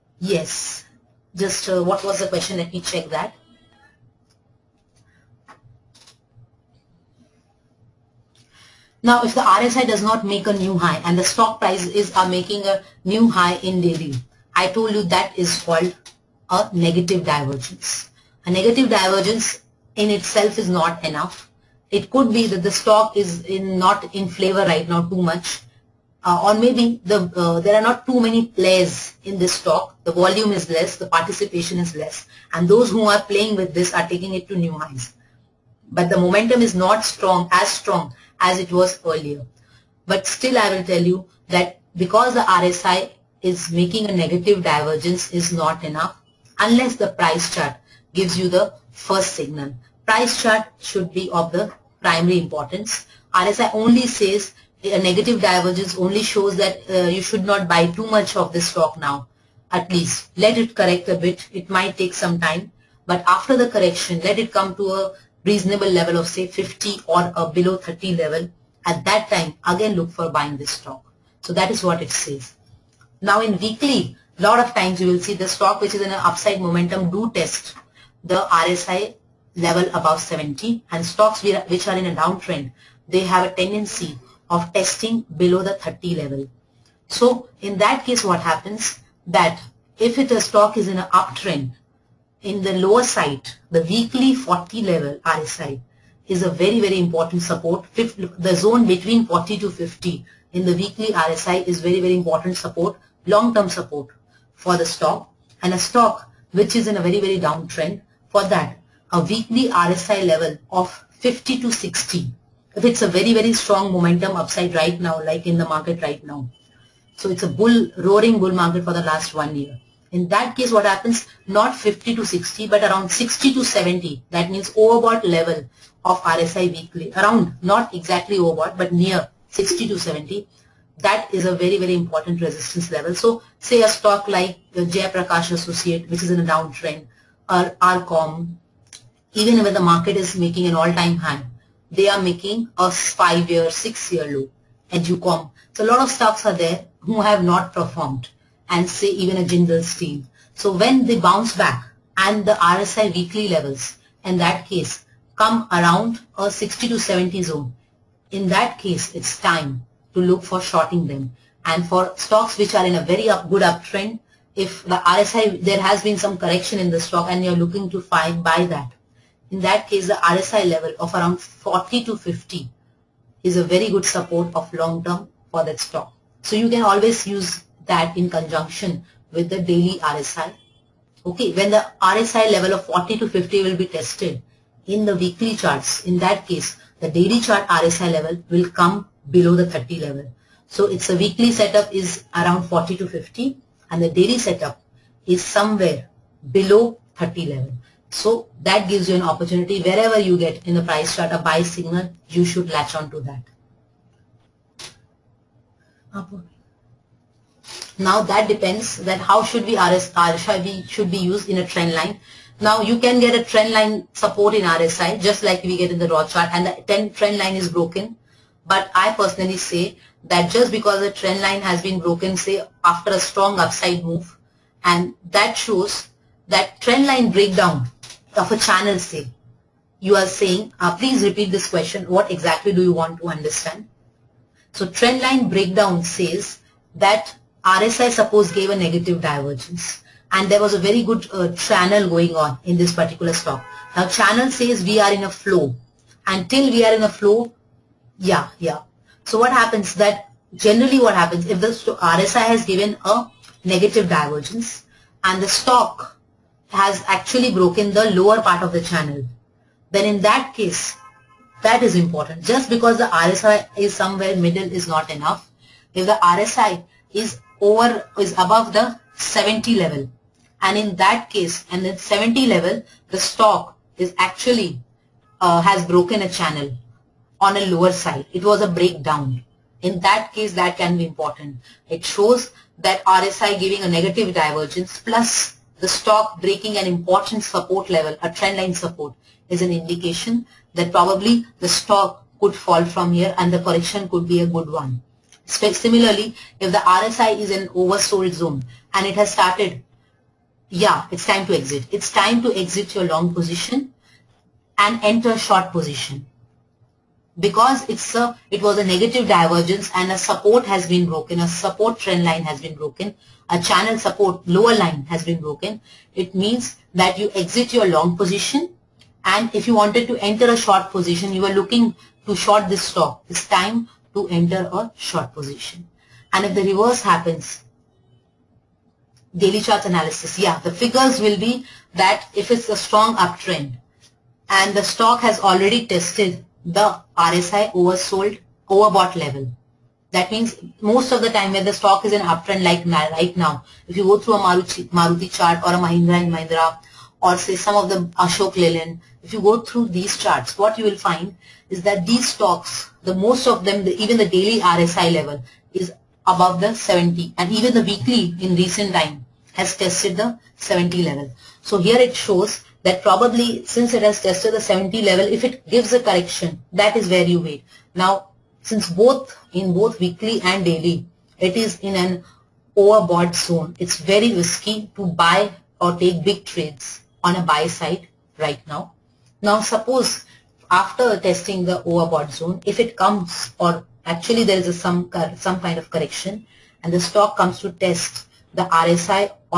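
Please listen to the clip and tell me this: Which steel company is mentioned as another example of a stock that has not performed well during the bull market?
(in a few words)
Jindal Steel.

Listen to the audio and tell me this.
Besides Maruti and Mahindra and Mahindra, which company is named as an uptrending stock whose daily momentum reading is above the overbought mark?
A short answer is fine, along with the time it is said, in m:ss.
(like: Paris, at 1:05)
Ashok Leyland, at 5:48.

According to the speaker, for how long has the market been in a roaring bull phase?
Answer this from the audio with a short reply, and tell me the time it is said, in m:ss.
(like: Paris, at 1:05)
One year, at 1:59.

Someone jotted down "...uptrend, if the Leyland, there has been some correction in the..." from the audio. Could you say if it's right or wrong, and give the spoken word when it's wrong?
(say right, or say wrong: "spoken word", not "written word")
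wrong: "RSI", not "Leyland".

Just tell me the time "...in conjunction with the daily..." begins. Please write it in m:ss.
2:58.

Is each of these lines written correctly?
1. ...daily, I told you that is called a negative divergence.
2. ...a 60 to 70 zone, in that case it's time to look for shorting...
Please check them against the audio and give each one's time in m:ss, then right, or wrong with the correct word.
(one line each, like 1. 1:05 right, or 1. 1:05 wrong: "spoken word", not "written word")
1. 0:13 right
2. 2:36 right.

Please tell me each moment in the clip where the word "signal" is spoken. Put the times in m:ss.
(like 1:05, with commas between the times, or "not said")
0:49, 3:21.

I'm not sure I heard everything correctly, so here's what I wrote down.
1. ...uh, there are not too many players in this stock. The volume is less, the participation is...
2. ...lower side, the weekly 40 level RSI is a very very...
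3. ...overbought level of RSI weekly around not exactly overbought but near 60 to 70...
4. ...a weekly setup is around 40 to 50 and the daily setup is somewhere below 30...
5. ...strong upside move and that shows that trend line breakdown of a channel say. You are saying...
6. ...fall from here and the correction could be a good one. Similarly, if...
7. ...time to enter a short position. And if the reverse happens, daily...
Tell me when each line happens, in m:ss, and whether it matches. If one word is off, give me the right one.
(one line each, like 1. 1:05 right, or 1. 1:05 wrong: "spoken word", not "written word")
1. 0:27 right
2. 1:32 right
3. 2:04 right
4. 3:11 right
5. 3:43 right
6. 4:52 right
7. 5:23 right.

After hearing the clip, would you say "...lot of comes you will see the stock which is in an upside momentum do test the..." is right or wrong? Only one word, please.
wrong.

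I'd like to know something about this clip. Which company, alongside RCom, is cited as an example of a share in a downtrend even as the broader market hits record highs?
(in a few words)
Jaiprakash Associate.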